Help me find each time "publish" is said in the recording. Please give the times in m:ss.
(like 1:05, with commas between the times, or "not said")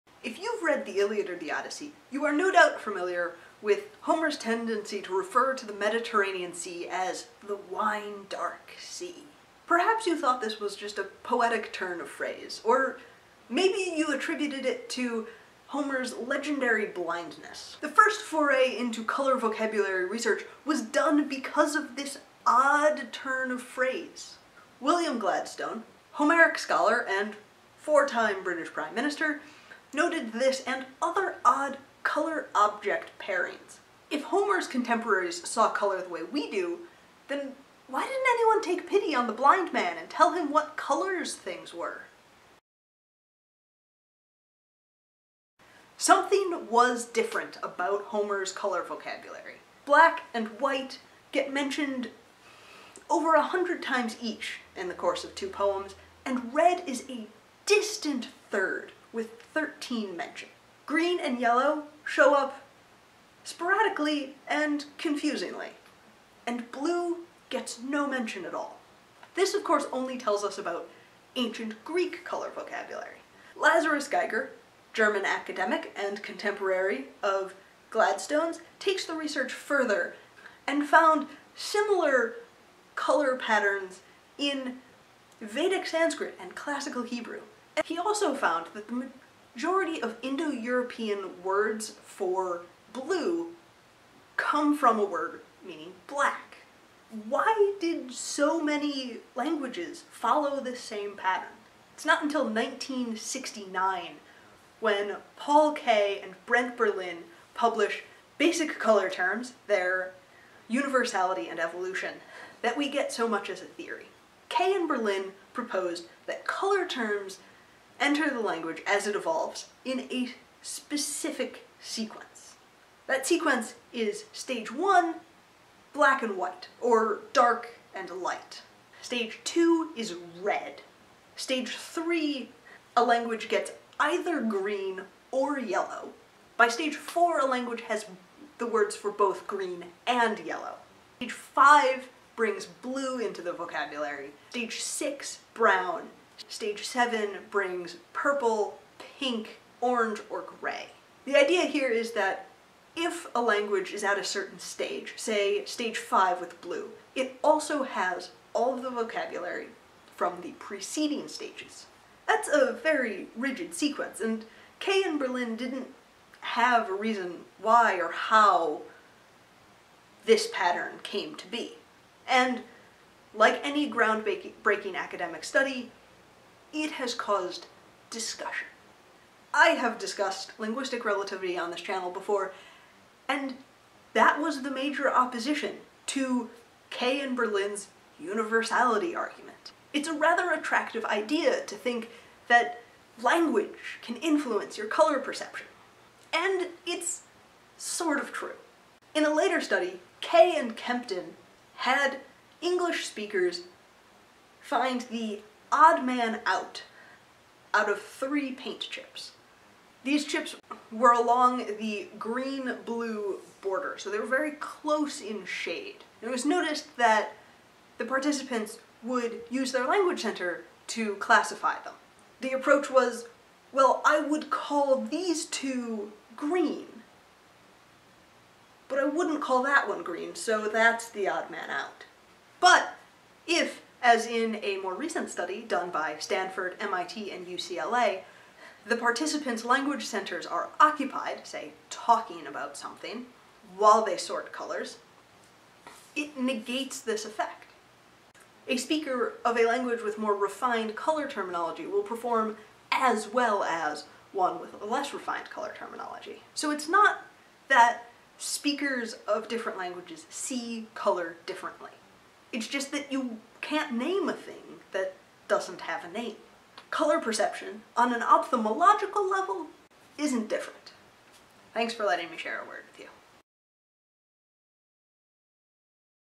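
1:47.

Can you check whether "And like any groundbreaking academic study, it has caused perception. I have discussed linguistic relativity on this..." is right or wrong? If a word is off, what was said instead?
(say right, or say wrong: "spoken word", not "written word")
wrong: "discussion", not "perception".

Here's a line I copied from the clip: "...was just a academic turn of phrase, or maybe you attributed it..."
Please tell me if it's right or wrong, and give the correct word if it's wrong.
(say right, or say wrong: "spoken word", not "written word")
wrong: "poetic", not "academic".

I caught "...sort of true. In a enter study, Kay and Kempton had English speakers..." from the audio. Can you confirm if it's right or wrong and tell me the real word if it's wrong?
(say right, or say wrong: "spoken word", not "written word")
wrong: "later", not "enter".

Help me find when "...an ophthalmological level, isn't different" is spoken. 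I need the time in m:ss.
4:28.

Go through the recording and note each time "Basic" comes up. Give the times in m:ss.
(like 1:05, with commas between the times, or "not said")
1:48.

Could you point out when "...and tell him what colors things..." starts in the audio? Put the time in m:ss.
0:39.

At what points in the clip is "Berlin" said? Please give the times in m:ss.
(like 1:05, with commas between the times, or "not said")
1:46, 1:54, 2:45, 3:07.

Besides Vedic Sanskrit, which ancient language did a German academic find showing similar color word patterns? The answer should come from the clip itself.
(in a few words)
classical Hebrew.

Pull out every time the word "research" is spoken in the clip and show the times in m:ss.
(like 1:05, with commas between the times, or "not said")
0:20, 1:19.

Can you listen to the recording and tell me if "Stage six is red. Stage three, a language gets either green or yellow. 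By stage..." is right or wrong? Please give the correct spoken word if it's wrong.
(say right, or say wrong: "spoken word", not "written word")
wrong: "two", not "six".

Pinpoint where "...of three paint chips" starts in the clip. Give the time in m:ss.
3:27.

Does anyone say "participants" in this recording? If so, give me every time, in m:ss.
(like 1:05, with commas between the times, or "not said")
3:38, 3:58.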